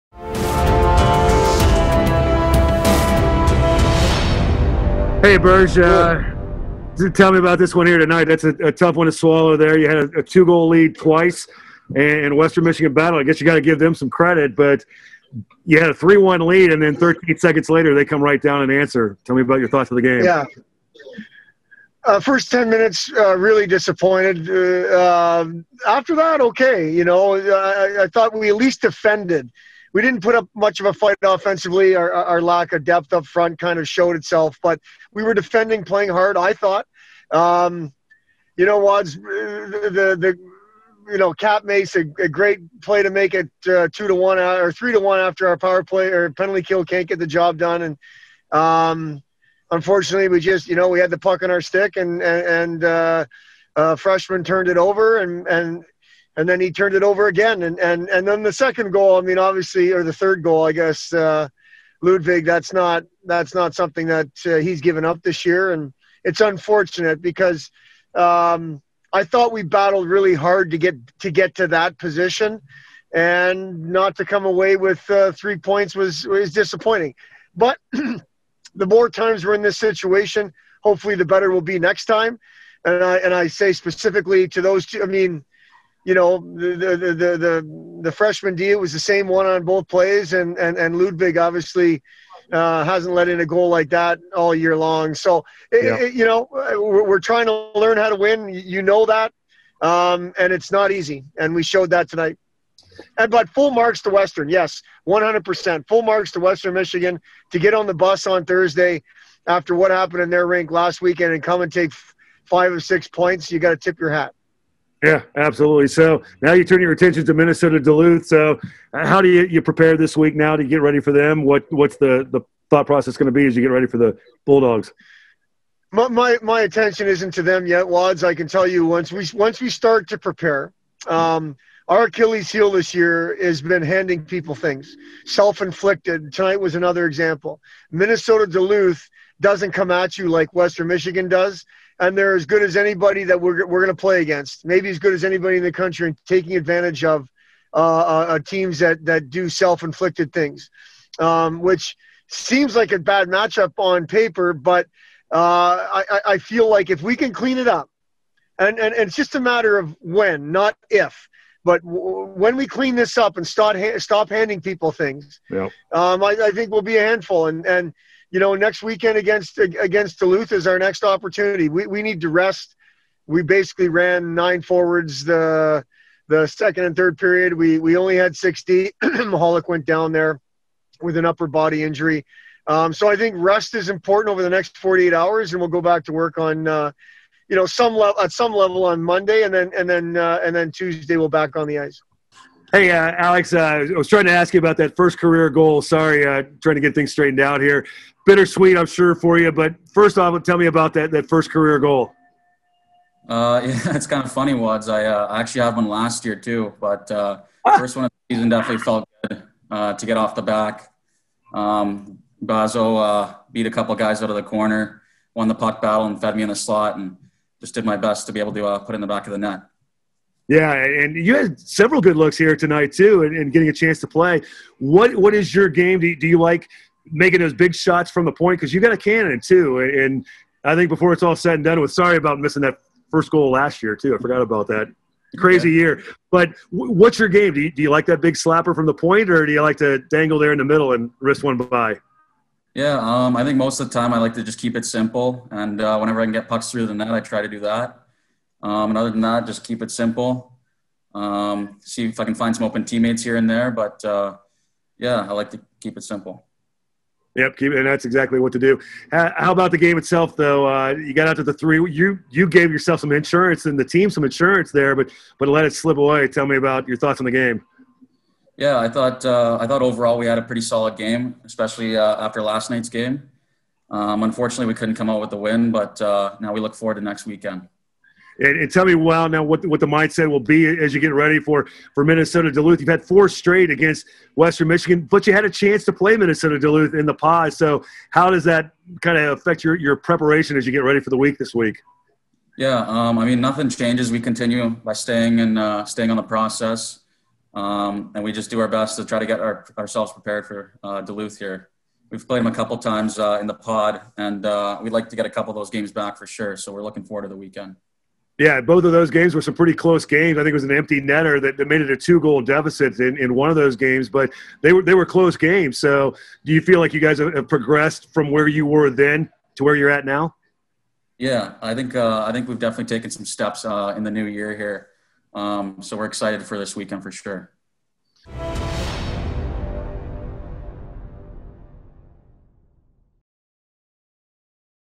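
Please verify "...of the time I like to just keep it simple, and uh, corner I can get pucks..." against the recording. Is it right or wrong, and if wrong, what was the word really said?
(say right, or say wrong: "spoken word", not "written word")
wrong: "whenever", not "corner".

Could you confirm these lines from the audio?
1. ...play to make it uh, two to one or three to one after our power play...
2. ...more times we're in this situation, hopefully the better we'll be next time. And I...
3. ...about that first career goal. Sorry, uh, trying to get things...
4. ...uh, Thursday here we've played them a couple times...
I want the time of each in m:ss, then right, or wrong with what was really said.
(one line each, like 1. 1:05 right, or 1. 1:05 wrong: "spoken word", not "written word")
1. 0:42 right
2. 1:18 right
3. 3:14 right
4. 5:00 wrong: "Duluth", not "Thursday".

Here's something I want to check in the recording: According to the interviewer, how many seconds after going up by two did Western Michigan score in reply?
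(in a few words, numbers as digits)
13.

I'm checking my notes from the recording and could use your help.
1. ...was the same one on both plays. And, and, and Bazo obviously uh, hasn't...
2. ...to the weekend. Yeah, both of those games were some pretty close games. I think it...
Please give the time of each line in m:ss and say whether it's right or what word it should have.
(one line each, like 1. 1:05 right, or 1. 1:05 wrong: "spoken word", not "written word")
1. 1:28 wrong: "Ludvig", not "Bazo"
2. 5:07 right.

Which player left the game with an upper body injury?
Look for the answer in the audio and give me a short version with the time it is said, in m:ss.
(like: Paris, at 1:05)
Mahalik, at 2:59.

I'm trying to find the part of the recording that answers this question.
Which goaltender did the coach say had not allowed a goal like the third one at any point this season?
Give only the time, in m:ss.
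1:02.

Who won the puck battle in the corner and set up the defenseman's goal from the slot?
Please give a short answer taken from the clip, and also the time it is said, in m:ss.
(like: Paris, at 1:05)
Bazo, at 3:32.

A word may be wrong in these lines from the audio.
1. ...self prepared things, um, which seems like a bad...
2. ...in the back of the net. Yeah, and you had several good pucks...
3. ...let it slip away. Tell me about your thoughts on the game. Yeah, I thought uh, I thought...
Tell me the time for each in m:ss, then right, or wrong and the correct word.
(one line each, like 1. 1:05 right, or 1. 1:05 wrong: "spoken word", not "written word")
1. 2:29 wrong: "inflicted", not "prepared"
2. 3:38 wrong: "looks", not "pucks"
3. 4:25 right.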